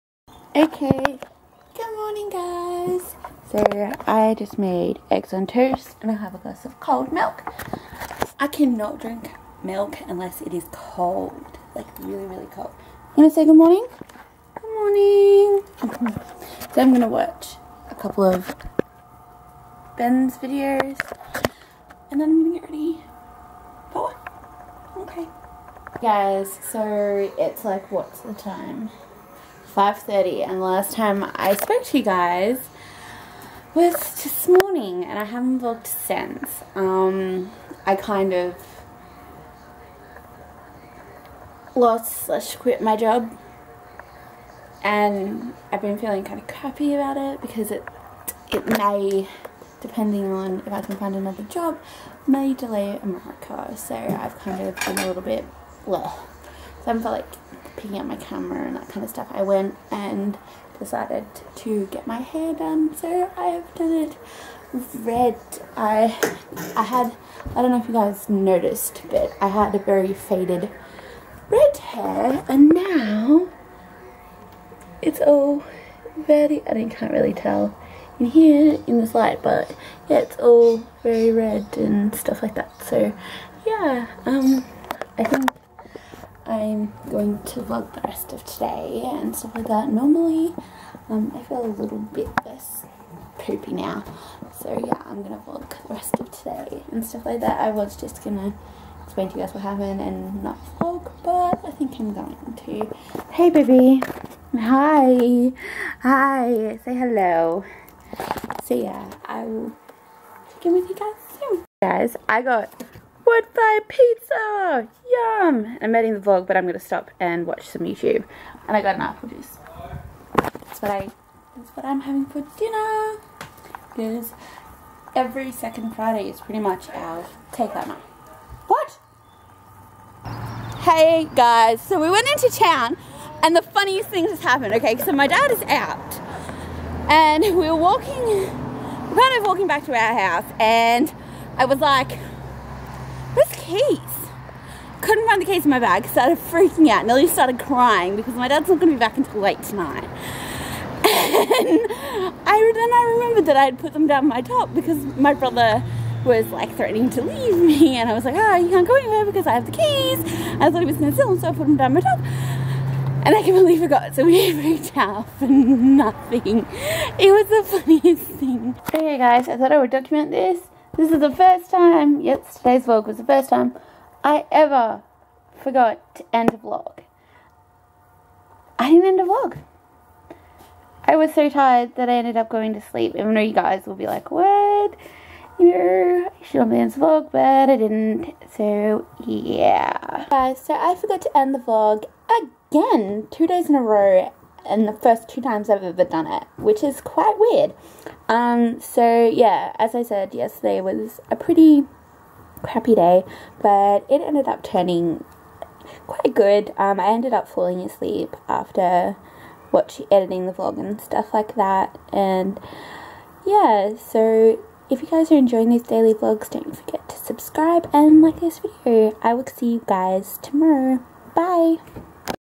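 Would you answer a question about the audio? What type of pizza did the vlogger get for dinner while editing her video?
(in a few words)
wood fire pizza.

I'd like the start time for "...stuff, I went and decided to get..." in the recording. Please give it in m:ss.
0:59.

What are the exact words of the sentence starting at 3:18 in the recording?
Um, so, yeah, as I said, yesterday was a pretty crappy day, but it ended up turning quite good.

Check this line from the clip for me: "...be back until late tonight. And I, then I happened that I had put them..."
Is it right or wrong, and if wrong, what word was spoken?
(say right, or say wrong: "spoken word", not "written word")
wrong: "remembered", not "happened".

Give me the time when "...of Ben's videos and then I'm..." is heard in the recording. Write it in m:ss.
0:18.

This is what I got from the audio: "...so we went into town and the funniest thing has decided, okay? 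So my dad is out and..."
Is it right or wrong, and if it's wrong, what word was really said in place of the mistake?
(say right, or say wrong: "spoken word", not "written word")
wrong: "happened", not "decided".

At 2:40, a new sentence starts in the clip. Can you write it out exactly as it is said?
I thought he was going to sell them, so I put them down my top.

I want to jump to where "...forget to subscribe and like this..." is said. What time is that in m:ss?
3:36.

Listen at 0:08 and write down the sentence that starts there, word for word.
I cannot drink milk unless it is cold, like really, really cold.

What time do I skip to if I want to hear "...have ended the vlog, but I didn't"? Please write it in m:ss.
3:06.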